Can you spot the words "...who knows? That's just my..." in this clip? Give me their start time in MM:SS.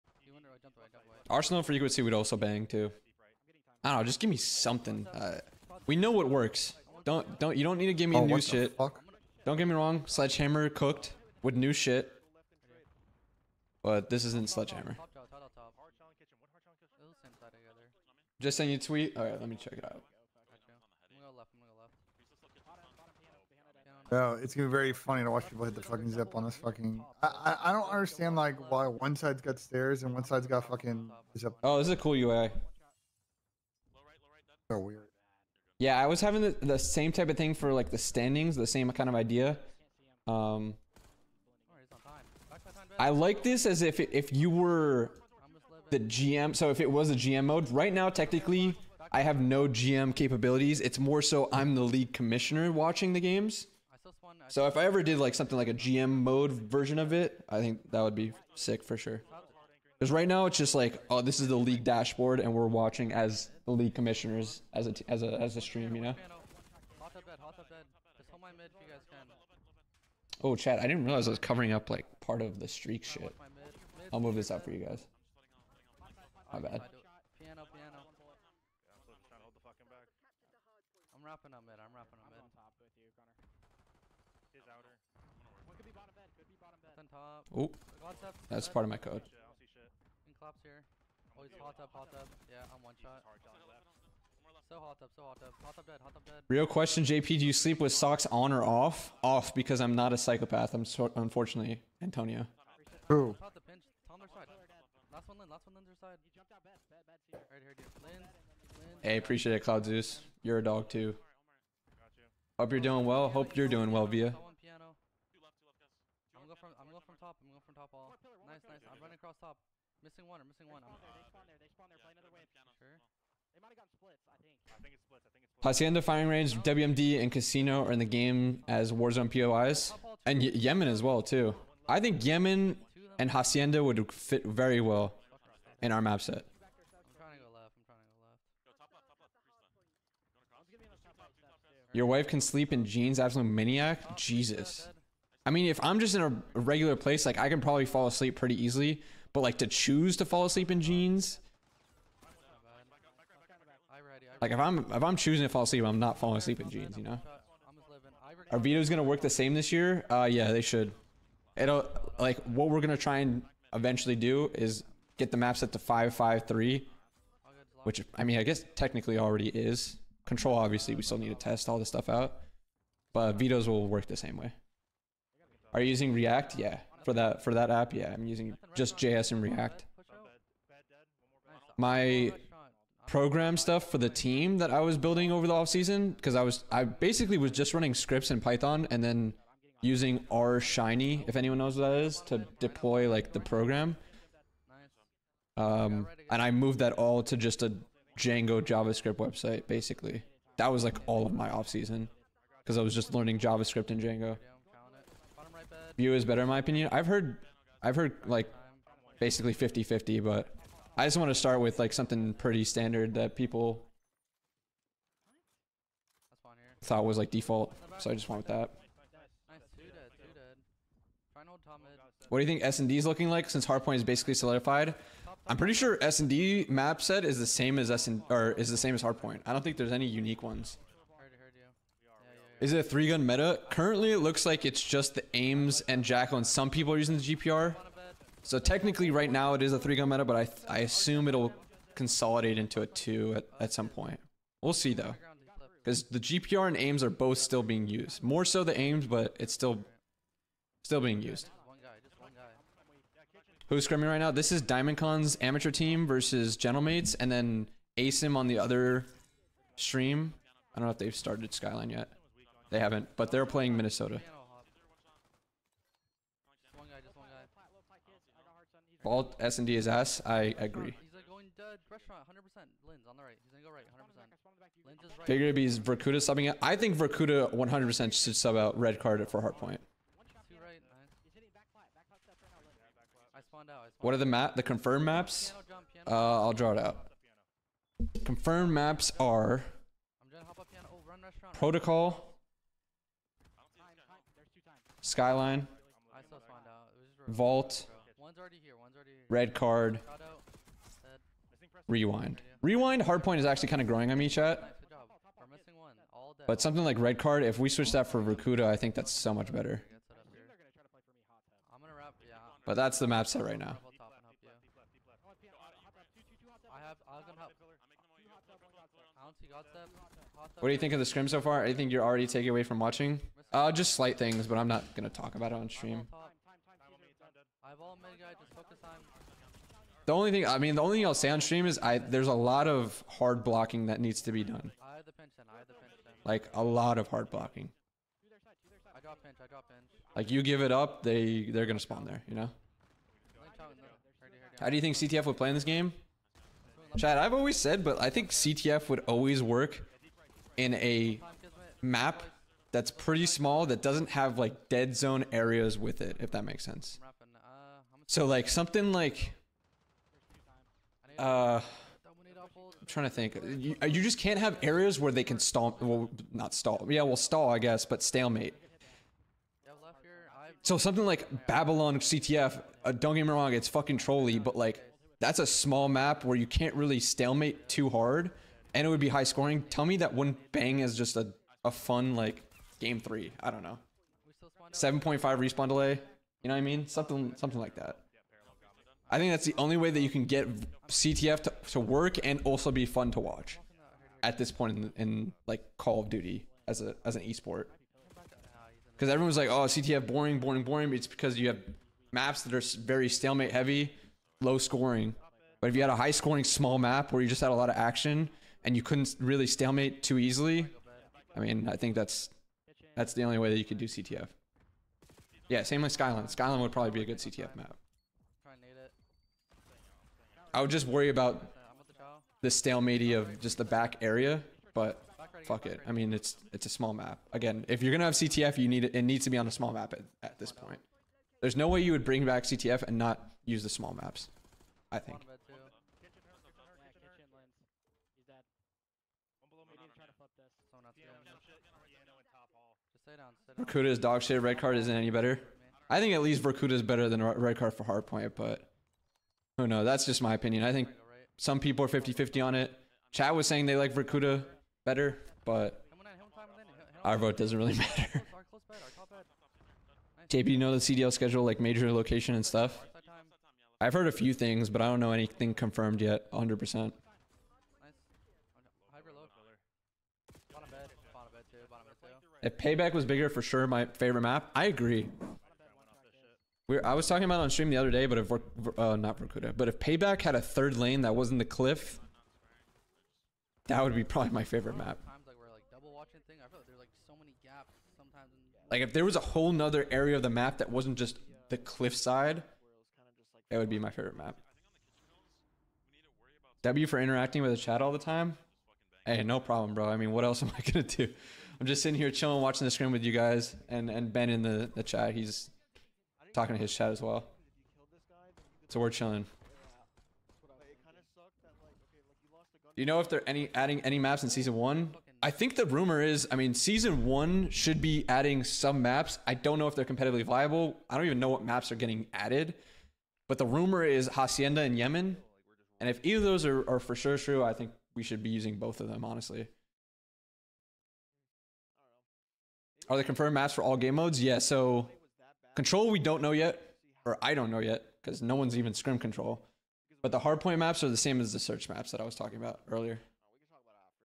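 07:29.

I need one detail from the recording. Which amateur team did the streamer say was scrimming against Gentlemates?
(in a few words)
Diamond Con.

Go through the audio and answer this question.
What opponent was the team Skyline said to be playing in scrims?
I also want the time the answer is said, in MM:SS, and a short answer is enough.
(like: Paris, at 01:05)
Minnesota, at 04:23.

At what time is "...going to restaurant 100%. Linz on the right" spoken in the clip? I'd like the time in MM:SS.
04:31.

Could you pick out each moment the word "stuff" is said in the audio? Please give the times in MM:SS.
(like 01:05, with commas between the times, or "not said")
02:51, 03:03, 07:42.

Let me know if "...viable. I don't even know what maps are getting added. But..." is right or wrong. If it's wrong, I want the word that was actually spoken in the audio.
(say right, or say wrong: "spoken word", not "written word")
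right.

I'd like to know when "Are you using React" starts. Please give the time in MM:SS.
02:55.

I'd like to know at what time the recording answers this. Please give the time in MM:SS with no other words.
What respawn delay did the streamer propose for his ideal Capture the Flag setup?
06:24.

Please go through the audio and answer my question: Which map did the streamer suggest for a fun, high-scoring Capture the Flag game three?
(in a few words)
Babylon.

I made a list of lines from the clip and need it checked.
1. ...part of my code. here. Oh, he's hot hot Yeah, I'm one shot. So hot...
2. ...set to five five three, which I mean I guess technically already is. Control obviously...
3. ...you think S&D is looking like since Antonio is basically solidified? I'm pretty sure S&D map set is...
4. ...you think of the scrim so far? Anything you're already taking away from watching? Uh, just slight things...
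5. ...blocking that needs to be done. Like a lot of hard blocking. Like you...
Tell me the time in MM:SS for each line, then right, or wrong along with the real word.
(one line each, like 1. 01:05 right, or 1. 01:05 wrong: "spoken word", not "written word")
1. 01:28 right
2. 02:45 right
3. 03:42 wrong: "Hardpoint", not "Antonio"
4. 05:20 right
5. 05:33 right.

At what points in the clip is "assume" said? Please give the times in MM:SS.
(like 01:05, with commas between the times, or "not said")
04:00.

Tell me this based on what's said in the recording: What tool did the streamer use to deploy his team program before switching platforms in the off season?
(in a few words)
R Shiny.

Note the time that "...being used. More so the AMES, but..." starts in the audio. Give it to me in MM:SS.
04:07.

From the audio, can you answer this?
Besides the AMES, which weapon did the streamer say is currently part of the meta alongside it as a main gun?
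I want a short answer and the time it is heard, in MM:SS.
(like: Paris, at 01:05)
Jackal, at 03:56.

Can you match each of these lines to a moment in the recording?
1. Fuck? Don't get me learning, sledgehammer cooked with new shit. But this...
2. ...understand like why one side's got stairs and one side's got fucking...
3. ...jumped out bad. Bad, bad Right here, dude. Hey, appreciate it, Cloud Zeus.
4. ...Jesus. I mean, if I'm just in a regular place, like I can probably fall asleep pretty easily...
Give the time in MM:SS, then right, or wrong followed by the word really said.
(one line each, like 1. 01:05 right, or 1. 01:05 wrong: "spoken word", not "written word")
1. 00:08 wrong: "wrong", not "learning"
2. 00:27 right
3. 01:46 right
4. 02:24 right.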